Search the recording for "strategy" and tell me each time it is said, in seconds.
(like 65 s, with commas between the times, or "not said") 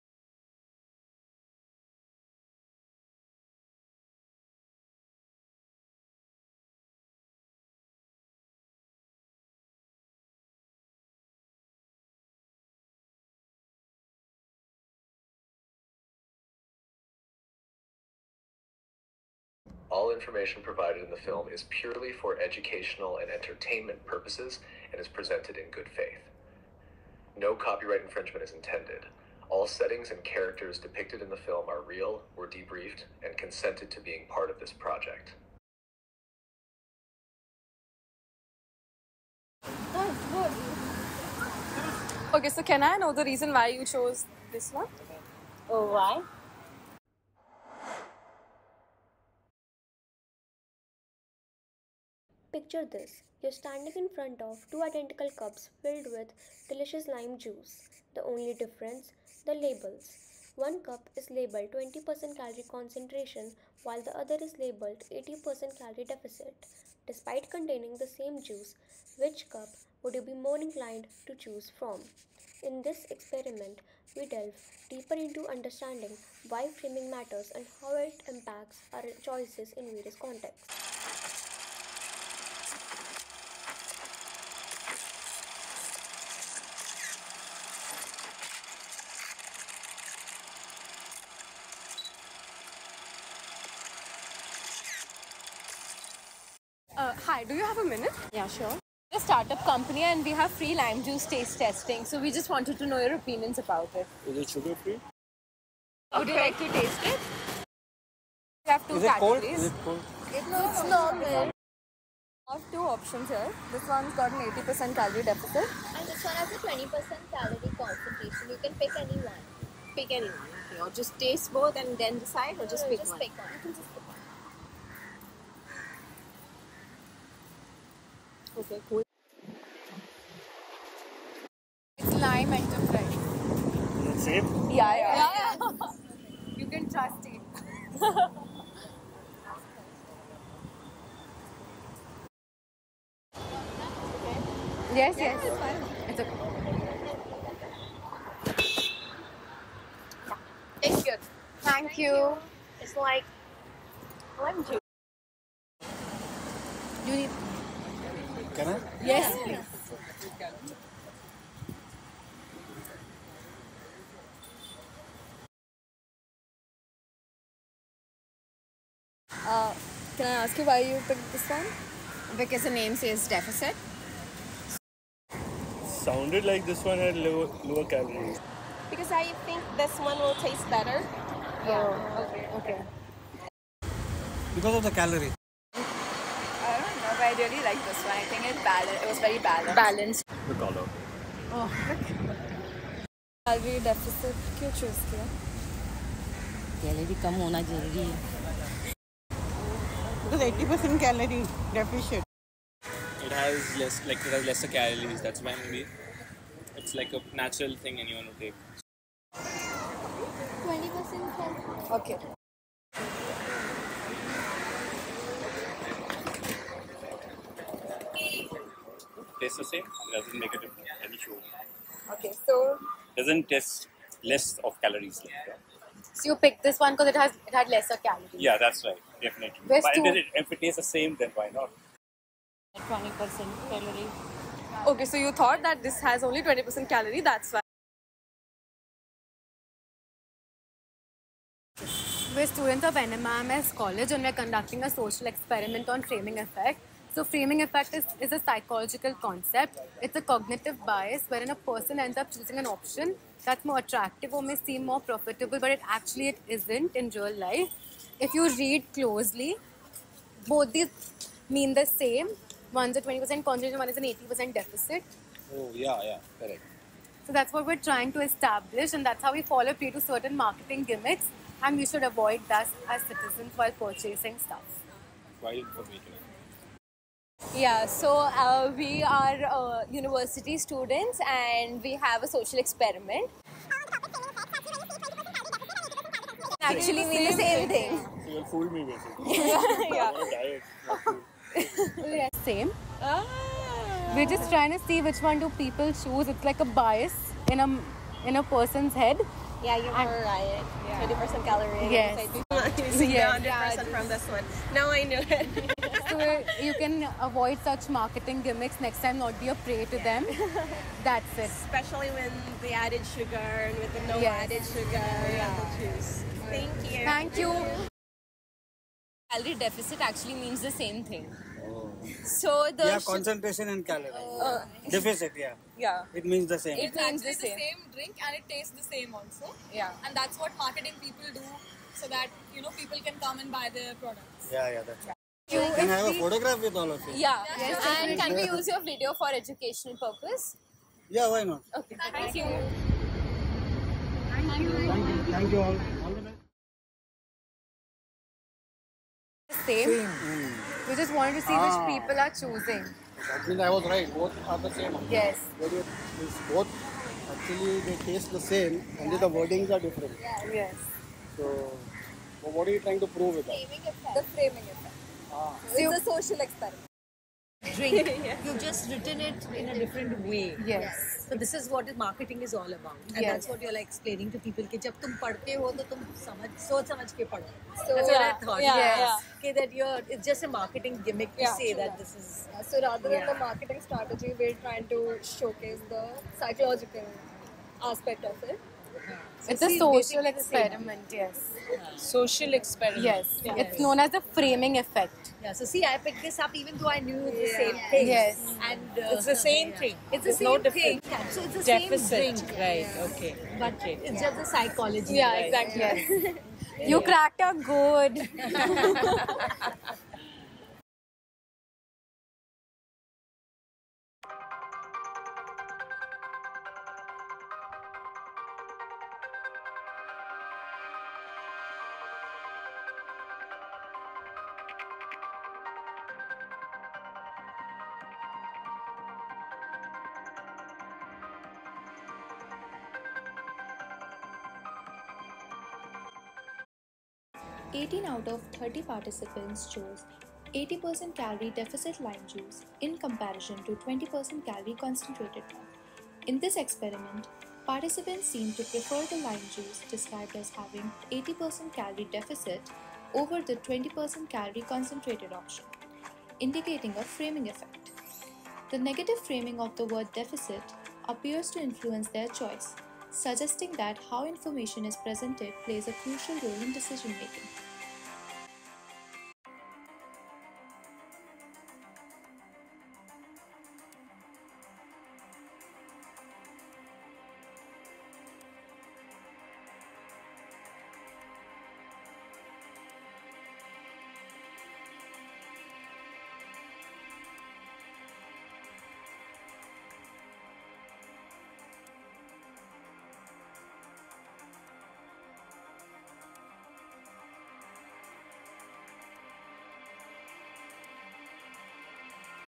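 383 s.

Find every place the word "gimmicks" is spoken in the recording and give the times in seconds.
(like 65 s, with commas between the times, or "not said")
270 s, 308 s, 381 s.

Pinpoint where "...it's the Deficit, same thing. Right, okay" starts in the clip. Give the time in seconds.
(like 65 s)
401 s.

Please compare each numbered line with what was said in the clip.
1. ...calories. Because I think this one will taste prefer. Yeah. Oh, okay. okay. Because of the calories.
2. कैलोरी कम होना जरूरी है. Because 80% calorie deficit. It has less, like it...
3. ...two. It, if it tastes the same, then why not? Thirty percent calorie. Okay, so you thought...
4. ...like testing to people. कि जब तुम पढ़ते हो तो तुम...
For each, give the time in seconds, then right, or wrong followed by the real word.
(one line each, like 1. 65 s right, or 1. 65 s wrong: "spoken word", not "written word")
1. 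177 s wrong: "better", not "prefer"
2. 196 s right
3. 230 s wrong: "Twenty", not "Thirty"
4. 373 s wrong: "explaining", not "testing".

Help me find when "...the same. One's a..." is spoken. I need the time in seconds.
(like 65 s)
261 s.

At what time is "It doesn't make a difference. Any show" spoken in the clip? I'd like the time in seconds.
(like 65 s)
219 s.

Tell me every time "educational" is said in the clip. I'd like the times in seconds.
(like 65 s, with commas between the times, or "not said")
22 s, 339 s.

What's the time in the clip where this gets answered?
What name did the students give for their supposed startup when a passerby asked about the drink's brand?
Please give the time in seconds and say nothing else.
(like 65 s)
132 s.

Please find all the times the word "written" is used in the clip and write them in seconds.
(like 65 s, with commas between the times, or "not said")
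368 s.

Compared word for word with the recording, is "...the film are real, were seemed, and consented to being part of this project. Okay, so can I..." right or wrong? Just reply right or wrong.
wrong.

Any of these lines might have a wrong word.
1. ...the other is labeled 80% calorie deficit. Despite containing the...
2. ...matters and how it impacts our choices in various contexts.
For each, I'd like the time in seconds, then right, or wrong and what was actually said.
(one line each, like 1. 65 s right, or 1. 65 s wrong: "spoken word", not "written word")
1. 64 s right
2. 77 s right.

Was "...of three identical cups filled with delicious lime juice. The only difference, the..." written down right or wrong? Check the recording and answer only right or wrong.
wrong.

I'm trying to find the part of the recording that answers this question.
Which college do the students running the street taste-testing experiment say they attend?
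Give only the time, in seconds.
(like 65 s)
242 s.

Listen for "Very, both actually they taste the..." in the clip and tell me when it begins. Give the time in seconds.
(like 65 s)
355 s.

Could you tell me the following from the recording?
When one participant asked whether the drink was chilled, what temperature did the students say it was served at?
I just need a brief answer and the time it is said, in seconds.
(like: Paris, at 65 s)
Normal, at 110 s.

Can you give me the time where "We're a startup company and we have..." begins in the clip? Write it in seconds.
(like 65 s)
99 s.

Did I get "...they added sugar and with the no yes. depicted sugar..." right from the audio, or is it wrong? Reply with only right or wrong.
wrong.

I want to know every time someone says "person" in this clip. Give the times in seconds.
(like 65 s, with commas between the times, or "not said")
251 s, 298 s.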